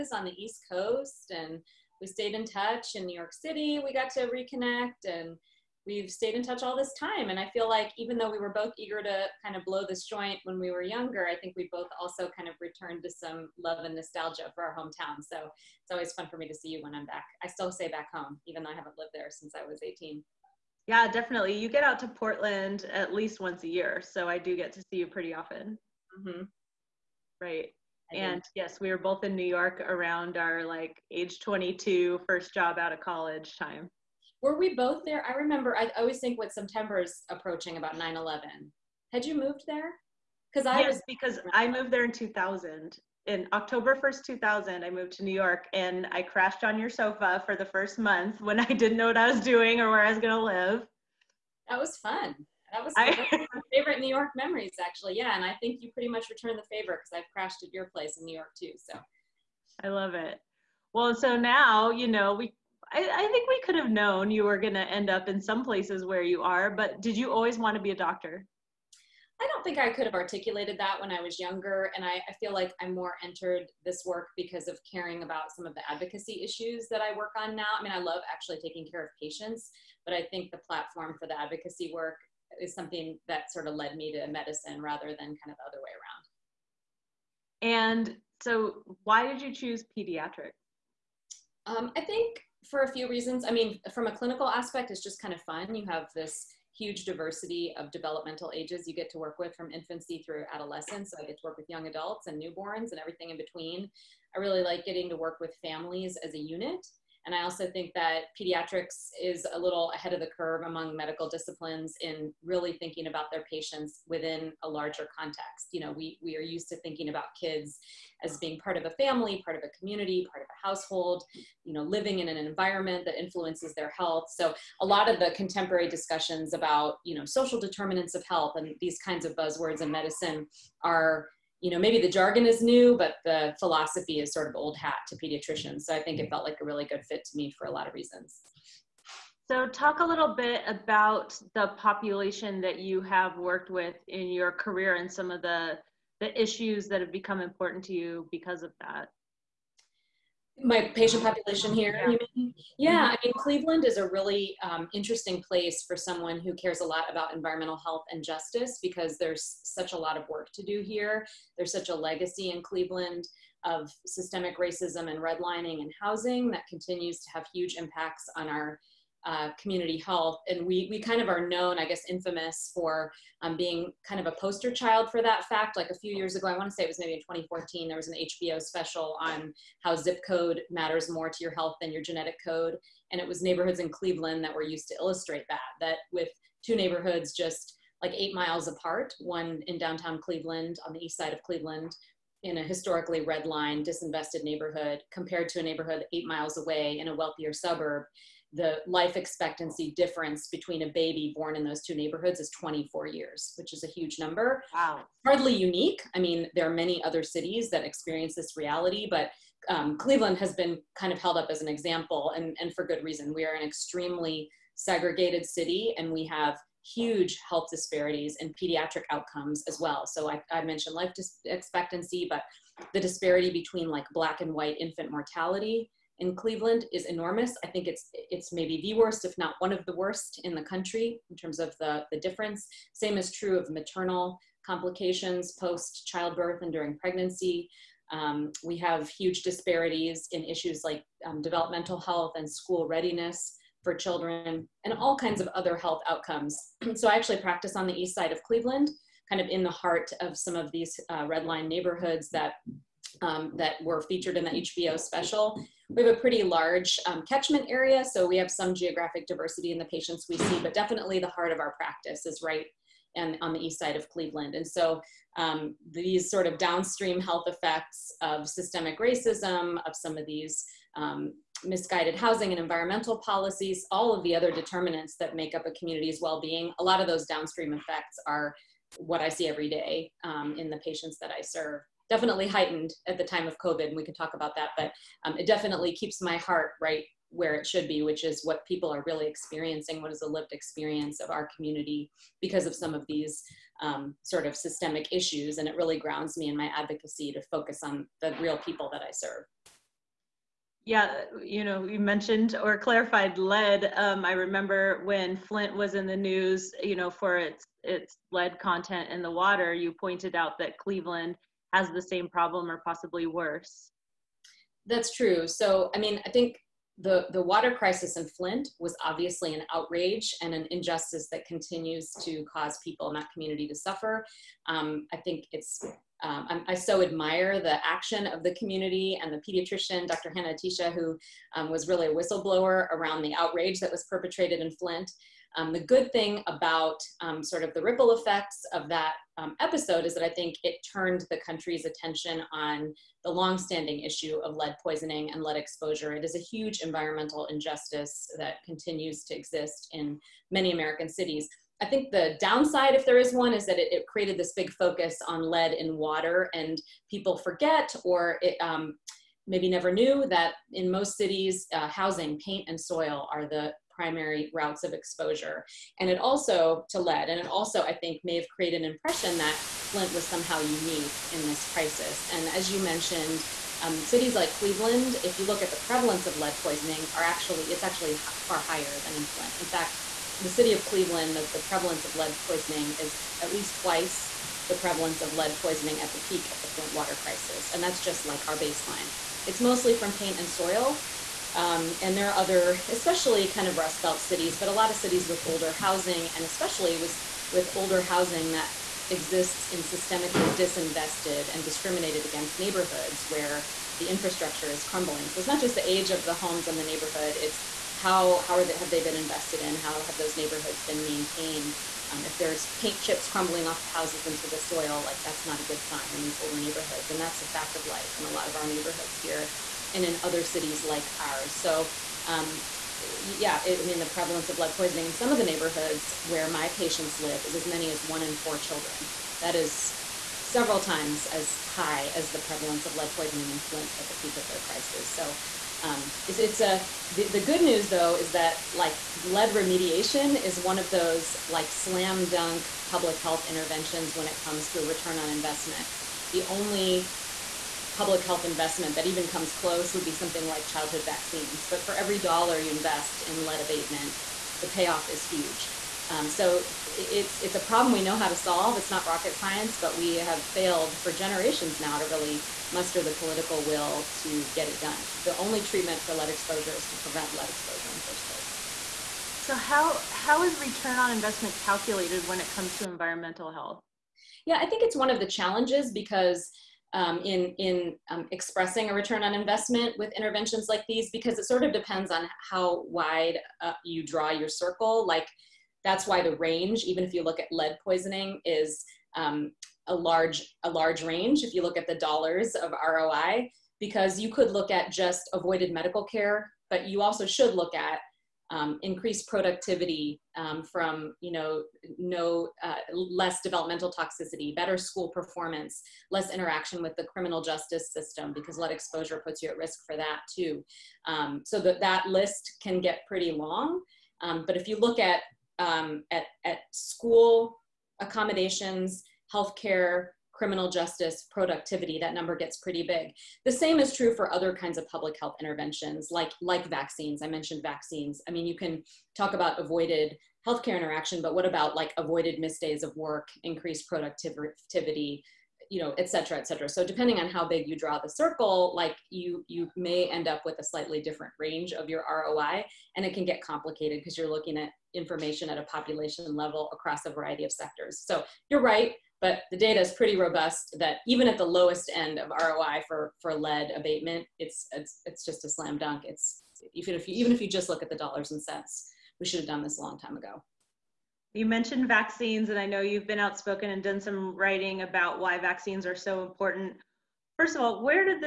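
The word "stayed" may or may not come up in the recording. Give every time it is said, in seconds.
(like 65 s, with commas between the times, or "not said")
2 s, 6 s.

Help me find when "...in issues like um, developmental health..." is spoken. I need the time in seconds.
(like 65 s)
240 s.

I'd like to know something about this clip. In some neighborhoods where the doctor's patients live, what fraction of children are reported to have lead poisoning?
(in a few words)
1 in 4.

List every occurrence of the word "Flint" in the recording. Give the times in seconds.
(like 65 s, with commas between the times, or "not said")
305 s, 318 s, 334 s, 369 s, 379 s, 386 s, 433 s.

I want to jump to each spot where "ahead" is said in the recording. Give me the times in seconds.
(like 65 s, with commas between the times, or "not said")
109 s.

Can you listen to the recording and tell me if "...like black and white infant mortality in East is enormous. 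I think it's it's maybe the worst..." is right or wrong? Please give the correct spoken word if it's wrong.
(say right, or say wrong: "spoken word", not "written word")
wrong: "Cleveland", not "East".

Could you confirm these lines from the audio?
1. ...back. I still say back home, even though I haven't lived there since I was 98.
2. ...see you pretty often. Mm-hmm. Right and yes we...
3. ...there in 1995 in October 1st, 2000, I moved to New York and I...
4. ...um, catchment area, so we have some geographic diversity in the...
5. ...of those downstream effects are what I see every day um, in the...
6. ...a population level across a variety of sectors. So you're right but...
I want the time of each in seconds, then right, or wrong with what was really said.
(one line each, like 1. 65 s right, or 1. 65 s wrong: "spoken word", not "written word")
1. 17 s wrong: "18", not "98"
2. 24 s right
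3. 41 s wrong: "2000", not "1995"
4. 257 s right
5. 276 s right
6. 545 s right.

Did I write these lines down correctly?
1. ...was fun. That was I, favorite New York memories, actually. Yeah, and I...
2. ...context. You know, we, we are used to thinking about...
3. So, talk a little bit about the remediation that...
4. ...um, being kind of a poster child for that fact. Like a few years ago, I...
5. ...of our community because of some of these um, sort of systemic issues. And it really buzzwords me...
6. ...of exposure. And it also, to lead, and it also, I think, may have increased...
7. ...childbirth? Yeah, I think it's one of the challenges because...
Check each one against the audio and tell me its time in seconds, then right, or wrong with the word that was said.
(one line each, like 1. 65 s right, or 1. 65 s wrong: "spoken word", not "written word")
1. 51 s right
2. 115 s right
3. 139 s wrong: "population", not "remediation"
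4. 173 s right
5. 291 s wrong: "grounds", not "buzzwords"
6. 364 s wrong: "created", not "increased"
7. 473 s wrong: "health", not "childbirth".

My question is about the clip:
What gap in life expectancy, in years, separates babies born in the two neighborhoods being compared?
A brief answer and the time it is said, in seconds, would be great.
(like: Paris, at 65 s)
24 years, at 202 s.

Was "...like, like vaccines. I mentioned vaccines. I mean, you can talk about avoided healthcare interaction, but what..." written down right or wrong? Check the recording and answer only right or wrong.
right.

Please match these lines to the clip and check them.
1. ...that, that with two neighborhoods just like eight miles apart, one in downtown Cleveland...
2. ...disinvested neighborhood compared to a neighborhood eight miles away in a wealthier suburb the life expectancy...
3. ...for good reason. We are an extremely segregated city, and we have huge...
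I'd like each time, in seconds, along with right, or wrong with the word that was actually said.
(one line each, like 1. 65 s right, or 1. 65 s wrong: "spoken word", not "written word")
1. 185 s right
2. 193 s right
3. 212 s right.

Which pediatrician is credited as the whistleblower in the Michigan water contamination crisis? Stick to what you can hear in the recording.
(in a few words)
Dr. Hanna-Attisha.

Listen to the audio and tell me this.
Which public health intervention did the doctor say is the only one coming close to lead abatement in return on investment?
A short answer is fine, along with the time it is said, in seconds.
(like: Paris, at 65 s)
Childhood vaccines, at 450 s.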